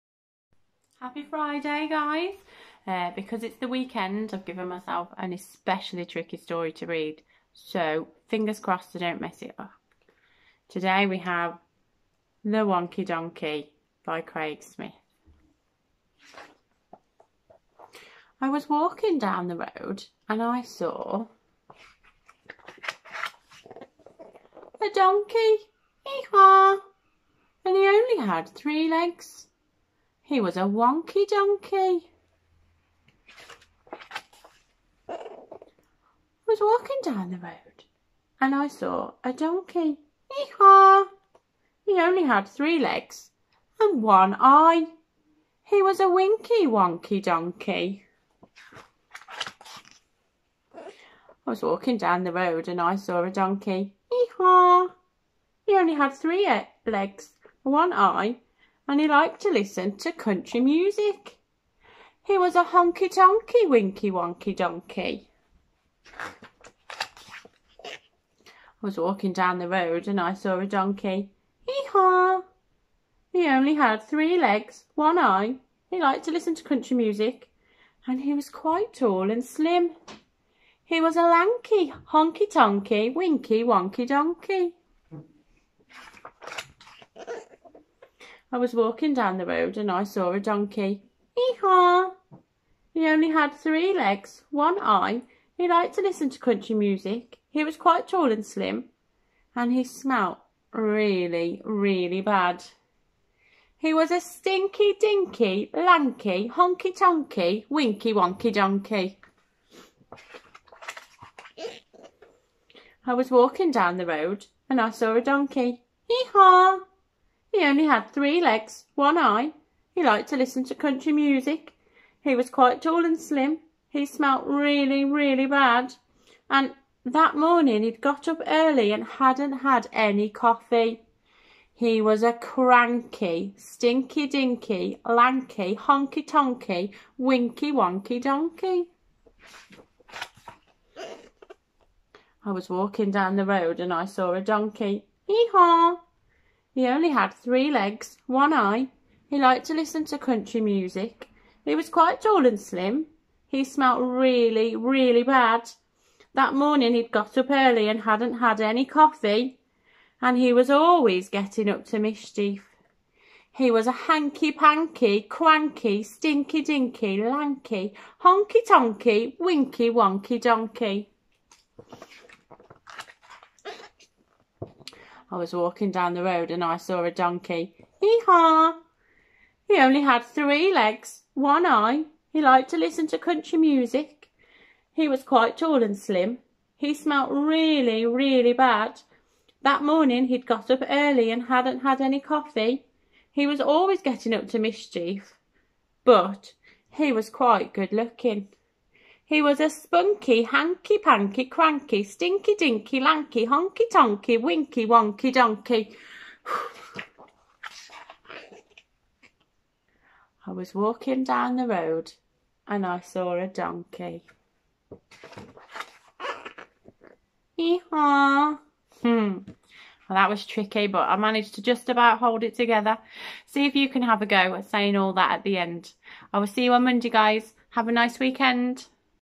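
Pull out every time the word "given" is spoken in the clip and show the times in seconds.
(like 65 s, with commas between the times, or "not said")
4 s.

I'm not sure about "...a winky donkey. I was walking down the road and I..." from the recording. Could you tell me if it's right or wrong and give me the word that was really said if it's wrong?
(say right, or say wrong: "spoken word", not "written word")
wrong: "wonky", not "winky".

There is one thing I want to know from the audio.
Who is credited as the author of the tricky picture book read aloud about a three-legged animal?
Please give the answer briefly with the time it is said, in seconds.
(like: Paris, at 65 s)
Craig Smith, at 14 s.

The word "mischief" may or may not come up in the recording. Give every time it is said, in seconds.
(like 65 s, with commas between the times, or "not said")
161 s, 194 s.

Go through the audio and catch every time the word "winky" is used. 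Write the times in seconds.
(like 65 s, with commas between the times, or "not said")
46 s, 63 s, 83 s, 107 s, 137 s, 169 s, 204 s.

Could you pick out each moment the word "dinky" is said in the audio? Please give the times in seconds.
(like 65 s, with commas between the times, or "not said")
104 s, 134 s, 166 s, 202 s.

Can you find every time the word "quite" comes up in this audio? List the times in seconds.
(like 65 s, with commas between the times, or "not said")
78 s, 97 s, 122 s, 151 s, 185 s, 197 s.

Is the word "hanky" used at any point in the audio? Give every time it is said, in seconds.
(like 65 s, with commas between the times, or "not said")
164 s, 200 s.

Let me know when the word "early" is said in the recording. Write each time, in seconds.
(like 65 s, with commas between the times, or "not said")
128 s, 157 s, 190 s.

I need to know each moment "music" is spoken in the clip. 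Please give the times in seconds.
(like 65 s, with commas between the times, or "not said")
60 s, 76 s, 96 s, 121 s, 150 s, 183 s.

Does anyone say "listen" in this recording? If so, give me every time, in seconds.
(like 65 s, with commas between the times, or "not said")
59 s, 76 s, 96 s, 120 s, 149 s, 182 s.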